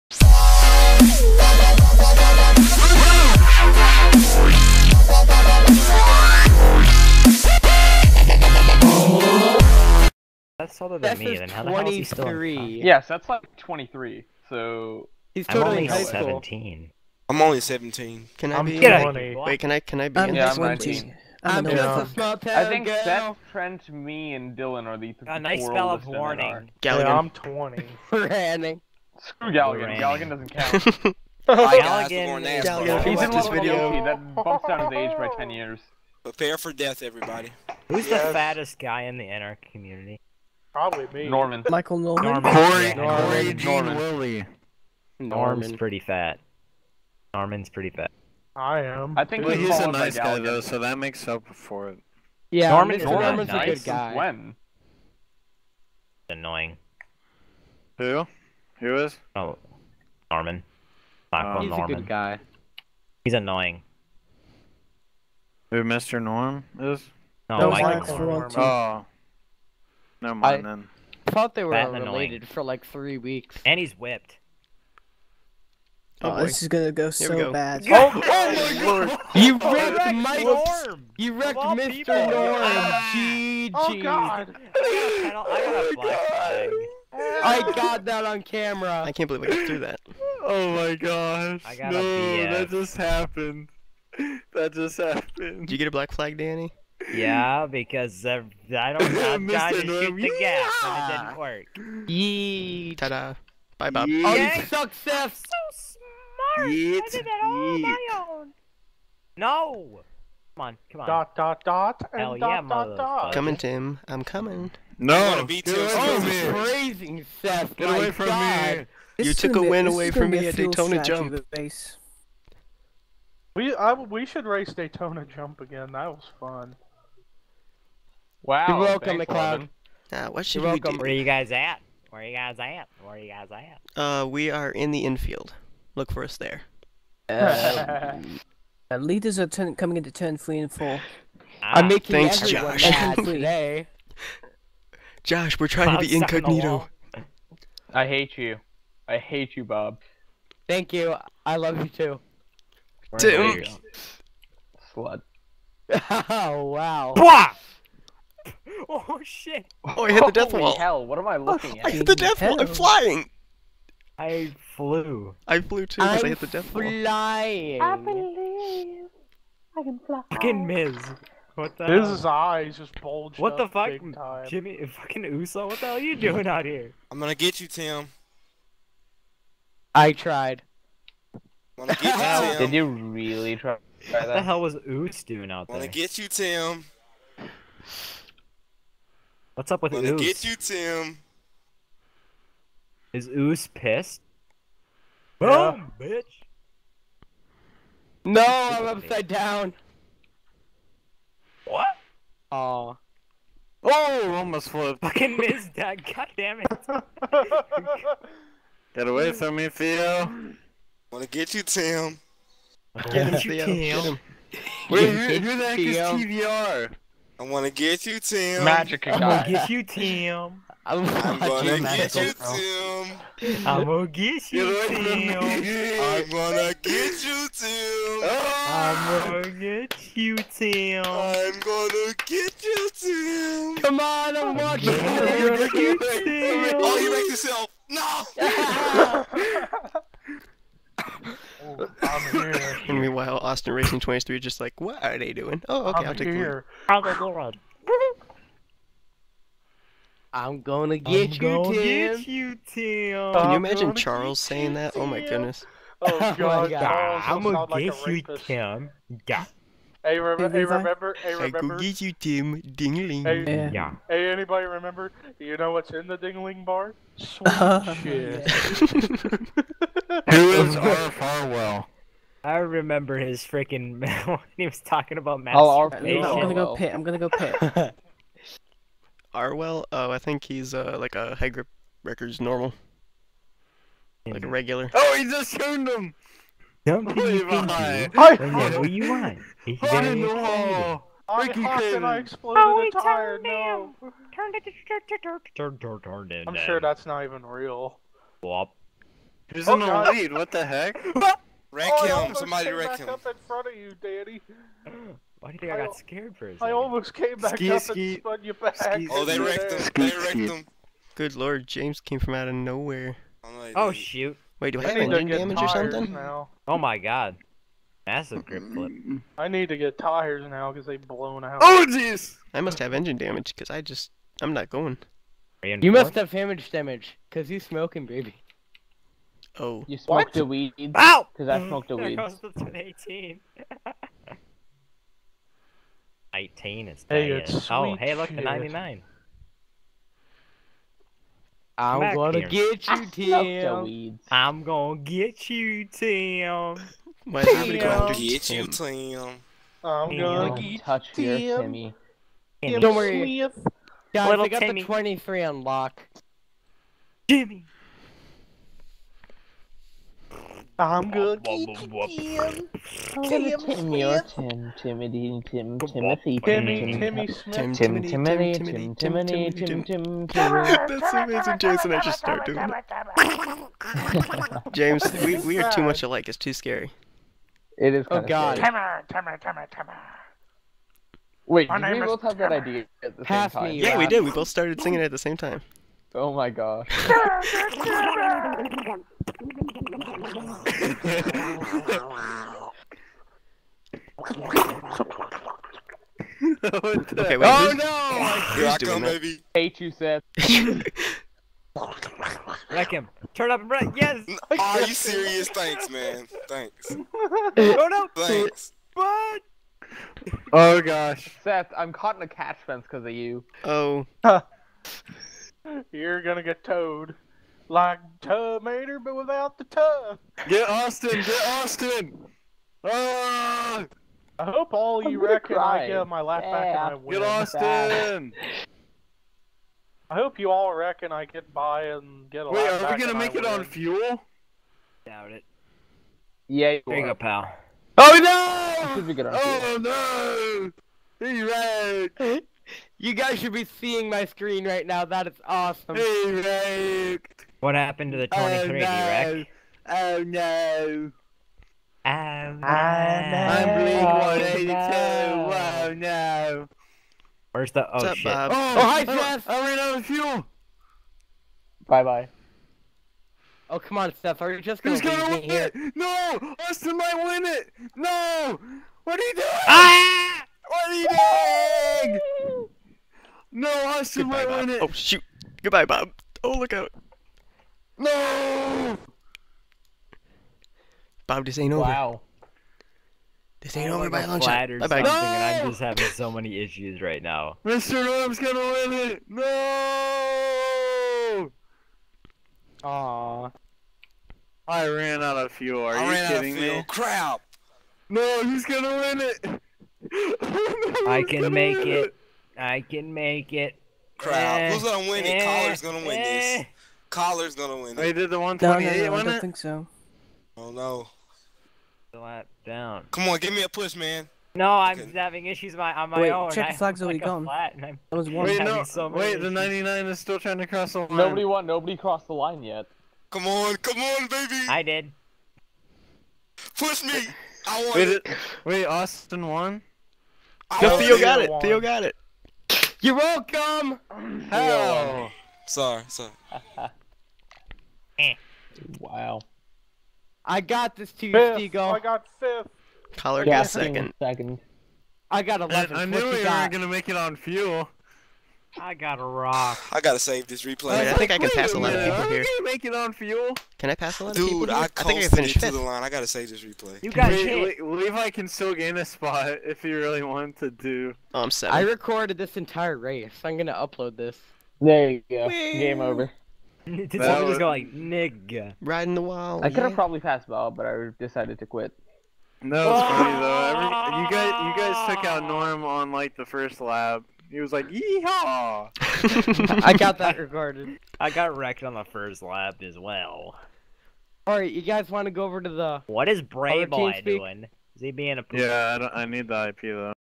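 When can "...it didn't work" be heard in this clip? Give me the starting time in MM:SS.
01:41.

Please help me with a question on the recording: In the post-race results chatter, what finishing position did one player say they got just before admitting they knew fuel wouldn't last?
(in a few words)
11.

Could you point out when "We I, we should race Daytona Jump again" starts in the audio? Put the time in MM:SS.
02:03.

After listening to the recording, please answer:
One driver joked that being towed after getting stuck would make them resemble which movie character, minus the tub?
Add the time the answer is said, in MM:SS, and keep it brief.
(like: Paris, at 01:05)
Terminator, at 06:58.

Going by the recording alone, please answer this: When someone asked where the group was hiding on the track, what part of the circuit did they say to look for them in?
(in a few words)
infield.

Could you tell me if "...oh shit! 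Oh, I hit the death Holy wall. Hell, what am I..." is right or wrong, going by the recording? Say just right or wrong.
right.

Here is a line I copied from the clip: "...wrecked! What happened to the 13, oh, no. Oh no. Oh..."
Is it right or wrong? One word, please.
wrong.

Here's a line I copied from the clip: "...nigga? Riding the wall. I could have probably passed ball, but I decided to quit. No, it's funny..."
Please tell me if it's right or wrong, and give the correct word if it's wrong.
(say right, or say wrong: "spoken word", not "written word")
right.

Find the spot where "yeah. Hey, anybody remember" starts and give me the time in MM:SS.
04:23.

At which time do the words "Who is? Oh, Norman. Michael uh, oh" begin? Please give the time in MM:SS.
00:58.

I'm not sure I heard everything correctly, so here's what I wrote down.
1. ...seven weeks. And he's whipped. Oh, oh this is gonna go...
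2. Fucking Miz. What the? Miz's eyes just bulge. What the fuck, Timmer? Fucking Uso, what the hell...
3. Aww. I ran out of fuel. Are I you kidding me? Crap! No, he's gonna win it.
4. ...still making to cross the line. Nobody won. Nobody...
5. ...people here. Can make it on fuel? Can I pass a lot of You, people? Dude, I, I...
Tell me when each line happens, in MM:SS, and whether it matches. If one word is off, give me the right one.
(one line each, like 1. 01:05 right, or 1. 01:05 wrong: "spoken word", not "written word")
1. 01:12 wrong: "three", not "seven"
2. 02:50 wrong: "Jimmy", not "Timmer"
3. 08:12 right
4. 08:40 wrong: "trying", not "making"
5. 09:12 wrong: "Dude", not "You".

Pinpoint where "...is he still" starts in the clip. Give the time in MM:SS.
00:11.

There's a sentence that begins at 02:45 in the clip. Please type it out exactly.
I flew too because I hit the death flying.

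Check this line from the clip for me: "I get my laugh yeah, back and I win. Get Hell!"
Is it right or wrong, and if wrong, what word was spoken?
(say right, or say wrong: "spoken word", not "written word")
wrong: "Austin", not "Hell".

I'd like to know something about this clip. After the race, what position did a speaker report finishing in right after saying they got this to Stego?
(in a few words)
fifth.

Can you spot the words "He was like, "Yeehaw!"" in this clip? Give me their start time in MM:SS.
09:37.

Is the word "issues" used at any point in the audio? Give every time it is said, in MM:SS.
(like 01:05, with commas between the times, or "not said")
08:06, 08:35.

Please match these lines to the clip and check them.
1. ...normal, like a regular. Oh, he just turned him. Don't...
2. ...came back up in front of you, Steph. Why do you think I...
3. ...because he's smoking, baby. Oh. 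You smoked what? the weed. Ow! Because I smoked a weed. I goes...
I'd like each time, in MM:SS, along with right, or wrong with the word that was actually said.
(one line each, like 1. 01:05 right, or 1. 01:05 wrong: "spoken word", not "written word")
1. 04:42 right
2. 05:03 wrong: "Danny", not "Steph"
3. 05:27 right.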